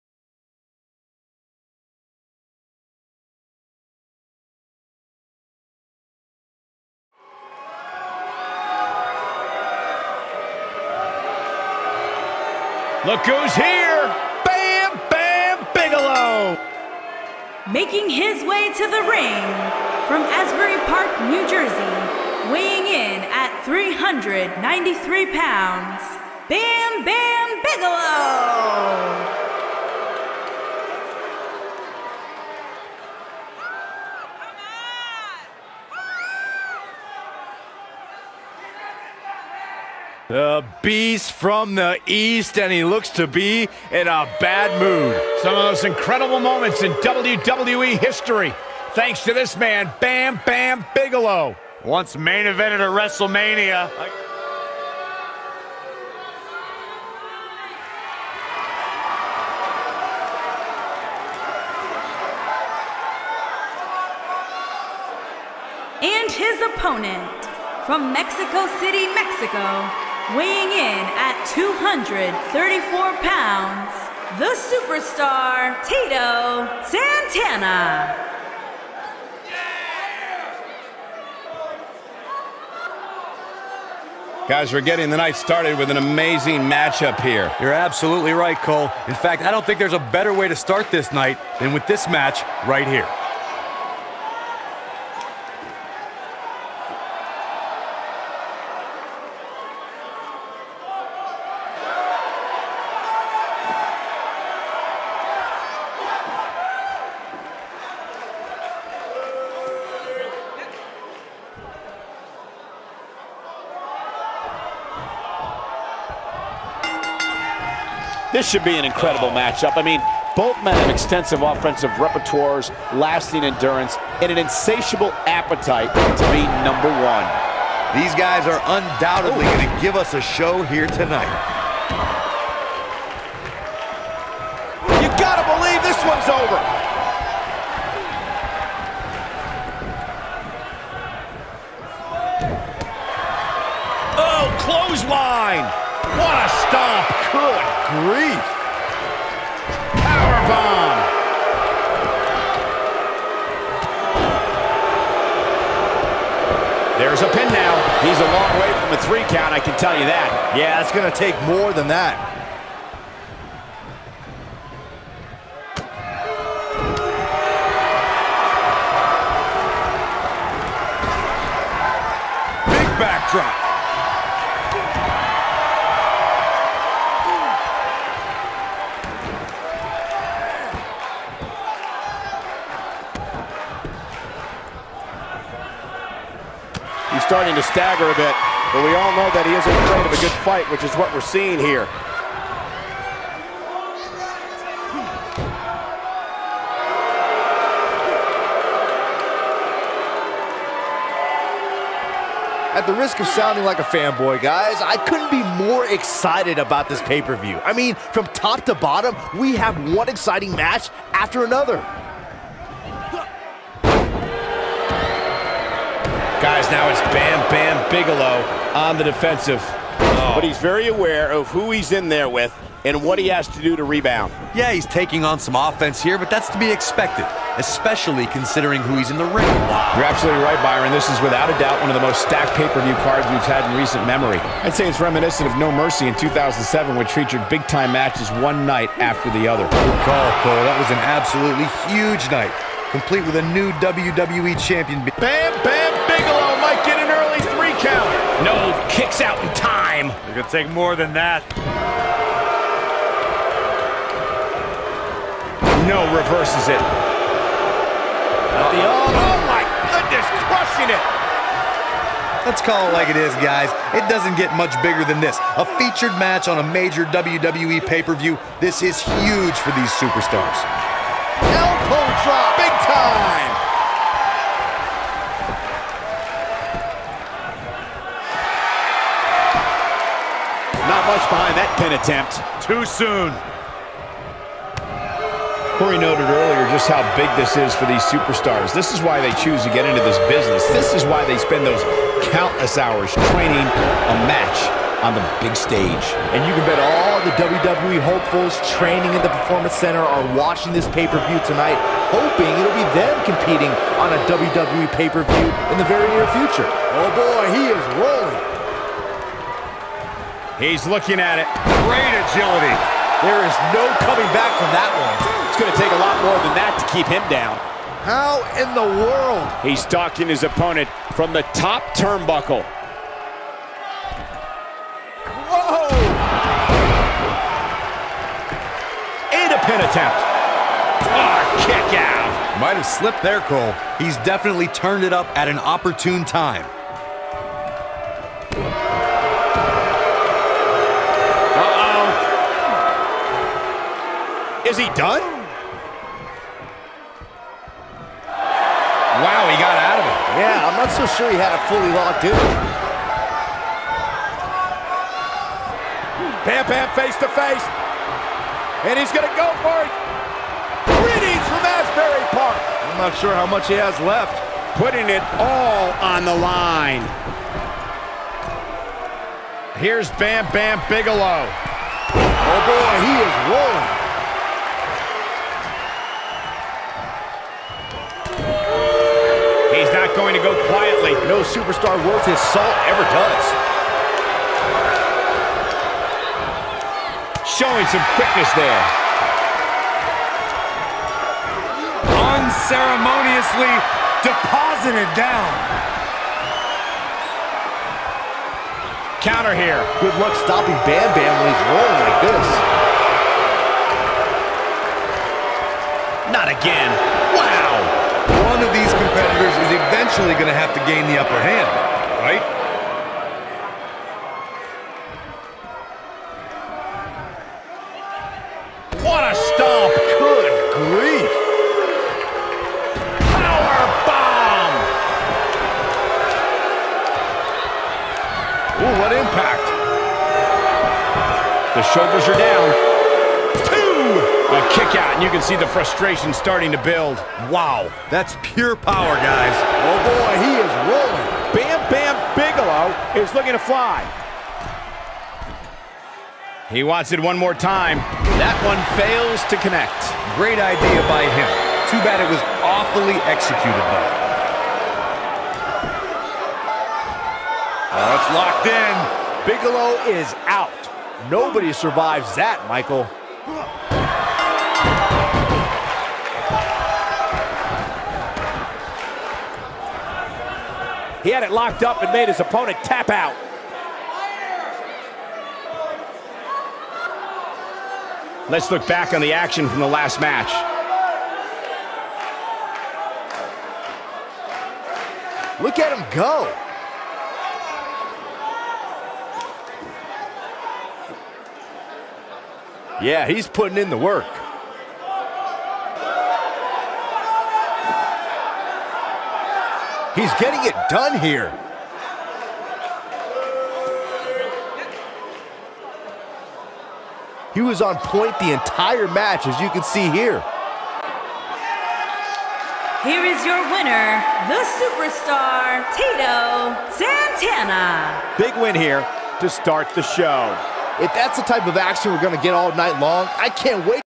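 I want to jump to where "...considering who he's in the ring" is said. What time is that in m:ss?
3:48.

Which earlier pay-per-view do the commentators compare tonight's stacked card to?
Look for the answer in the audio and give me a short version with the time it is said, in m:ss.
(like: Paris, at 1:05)
No Mercy, at 3:55.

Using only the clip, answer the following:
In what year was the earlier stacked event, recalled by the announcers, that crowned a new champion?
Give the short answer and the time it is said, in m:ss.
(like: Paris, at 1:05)
2007, at 3:56.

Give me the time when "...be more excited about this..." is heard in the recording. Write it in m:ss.
3:25.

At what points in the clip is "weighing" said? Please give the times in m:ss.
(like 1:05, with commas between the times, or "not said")
0:22, 1:10.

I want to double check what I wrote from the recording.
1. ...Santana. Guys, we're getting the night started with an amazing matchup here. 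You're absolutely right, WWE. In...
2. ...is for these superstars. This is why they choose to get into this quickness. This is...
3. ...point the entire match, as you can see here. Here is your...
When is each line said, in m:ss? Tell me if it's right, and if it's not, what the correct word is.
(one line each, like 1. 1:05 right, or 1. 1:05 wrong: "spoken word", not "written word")
1. 1:16 wrong: "Cole", not "WWE"
2. 4:47 wrong: "business", not "quickness"
3. 8:27 right.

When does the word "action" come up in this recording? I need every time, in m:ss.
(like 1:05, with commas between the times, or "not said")
7:59, 8:41.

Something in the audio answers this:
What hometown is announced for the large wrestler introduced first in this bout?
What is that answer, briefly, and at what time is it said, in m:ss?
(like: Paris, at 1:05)
Asbury Park, New Jersey, at 0:20.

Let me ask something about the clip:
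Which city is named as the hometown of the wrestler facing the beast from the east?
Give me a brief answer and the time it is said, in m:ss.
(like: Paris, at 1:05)
Mexico City, at 1:08.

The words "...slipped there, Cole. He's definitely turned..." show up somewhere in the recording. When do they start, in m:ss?
5:32.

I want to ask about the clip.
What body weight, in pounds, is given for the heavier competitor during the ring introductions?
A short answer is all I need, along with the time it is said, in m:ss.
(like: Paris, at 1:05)
393, at 0:23.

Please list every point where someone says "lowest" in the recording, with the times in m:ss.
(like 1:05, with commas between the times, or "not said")
not said.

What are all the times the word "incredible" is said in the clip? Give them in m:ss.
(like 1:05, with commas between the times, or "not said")
0:45, 1:58.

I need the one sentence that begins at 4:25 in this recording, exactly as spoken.
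A featured match on a major WWE pay-per-view.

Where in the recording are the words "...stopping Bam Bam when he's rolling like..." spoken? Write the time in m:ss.
6:40.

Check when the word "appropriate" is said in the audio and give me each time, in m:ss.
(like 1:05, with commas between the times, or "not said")
not said.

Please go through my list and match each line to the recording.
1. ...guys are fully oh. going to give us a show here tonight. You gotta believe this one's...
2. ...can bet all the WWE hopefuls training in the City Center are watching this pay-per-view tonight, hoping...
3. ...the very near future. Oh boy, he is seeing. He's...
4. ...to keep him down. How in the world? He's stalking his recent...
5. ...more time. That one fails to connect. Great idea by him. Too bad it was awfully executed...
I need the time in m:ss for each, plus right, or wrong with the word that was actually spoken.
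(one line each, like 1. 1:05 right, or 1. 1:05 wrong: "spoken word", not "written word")
1. 2:08 wrong: "undoubtedly", not "fully"
2. 4:56 wrong: "Performance", not "City"
3. 5:05 wrong: "rolling", not "seeing"
4. 5:16 wrong: "opponent", not "recent"
5. 7:27 right.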